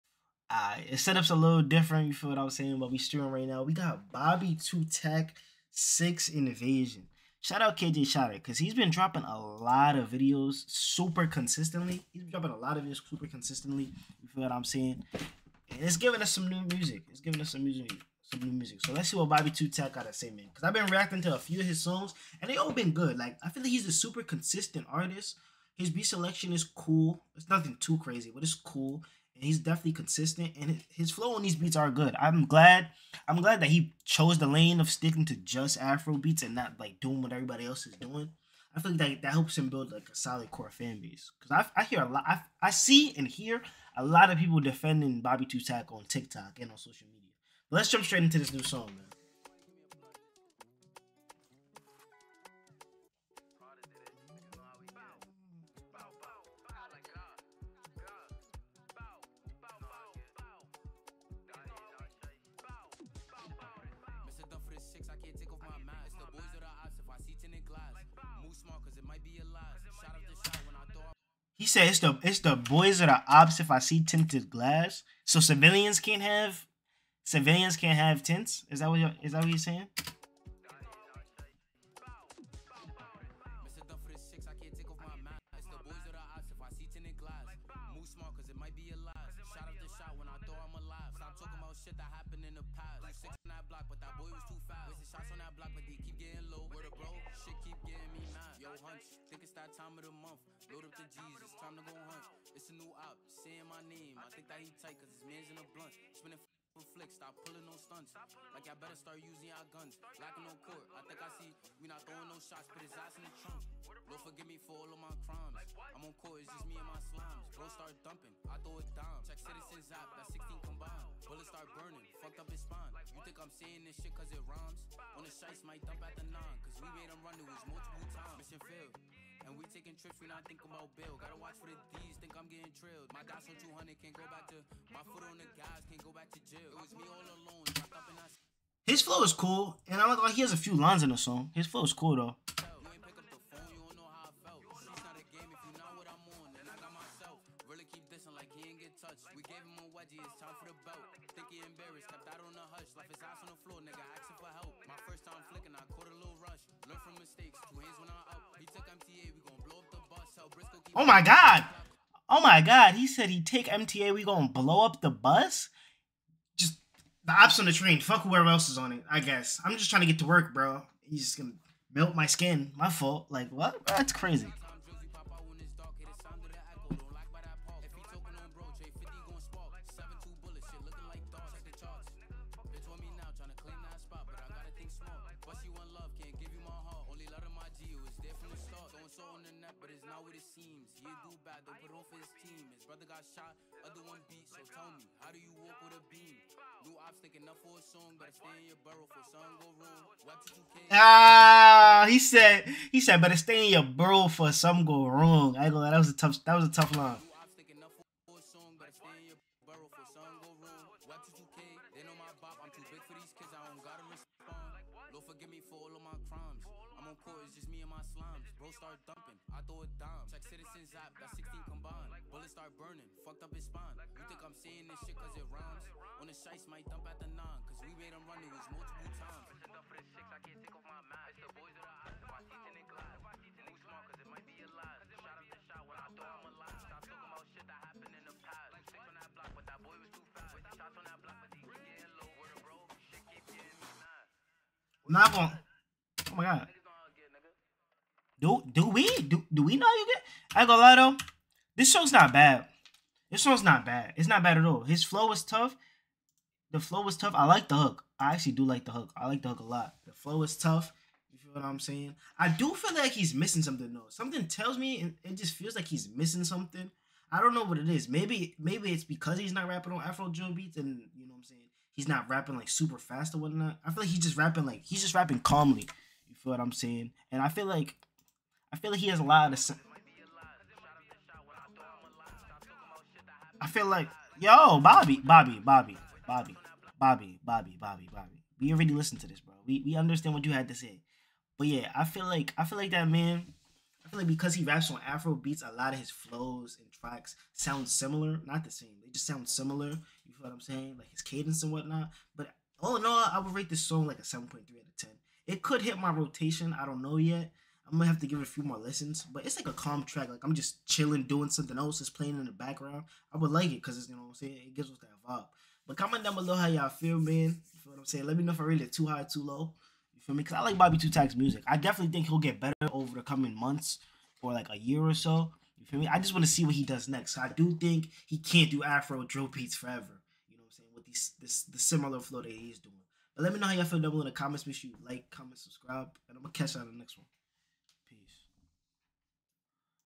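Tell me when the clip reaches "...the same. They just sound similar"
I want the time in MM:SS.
04:58.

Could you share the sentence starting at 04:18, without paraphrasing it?
I actually do like the hook.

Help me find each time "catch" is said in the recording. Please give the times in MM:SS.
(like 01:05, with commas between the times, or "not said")
05:36.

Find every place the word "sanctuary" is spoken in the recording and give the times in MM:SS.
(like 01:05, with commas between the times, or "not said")
not said.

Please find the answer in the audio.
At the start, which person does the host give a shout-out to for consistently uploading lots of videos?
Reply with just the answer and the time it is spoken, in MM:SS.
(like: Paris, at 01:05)
KJ Shatter, at 00:07.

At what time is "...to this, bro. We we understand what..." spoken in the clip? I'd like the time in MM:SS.
04:49.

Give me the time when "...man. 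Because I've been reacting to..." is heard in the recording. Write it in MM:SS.
00:20.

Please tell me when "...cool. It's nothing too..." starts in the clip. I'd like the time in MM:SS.
00:26.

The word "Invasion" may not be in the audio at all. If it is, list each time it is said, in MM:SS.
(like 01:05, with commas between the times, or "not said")
00:06.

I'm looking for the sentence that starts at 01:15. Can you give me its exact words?
So civilians can't have civilians can't have tints.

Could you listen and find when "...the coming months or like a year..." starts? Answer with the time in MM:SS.
05:23.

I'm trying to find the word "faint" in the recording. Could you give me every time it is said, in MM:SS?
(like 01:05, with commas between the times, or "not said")
not said.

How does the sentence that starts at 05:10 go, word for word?
Like I'm just chilling, doing something else.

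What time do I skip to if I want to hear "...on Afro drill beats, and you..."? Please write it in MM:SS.
04:29.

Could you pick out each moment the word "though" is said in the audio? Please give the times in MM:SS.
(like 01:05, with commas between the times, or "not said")
02:22, 04:10, 04:23.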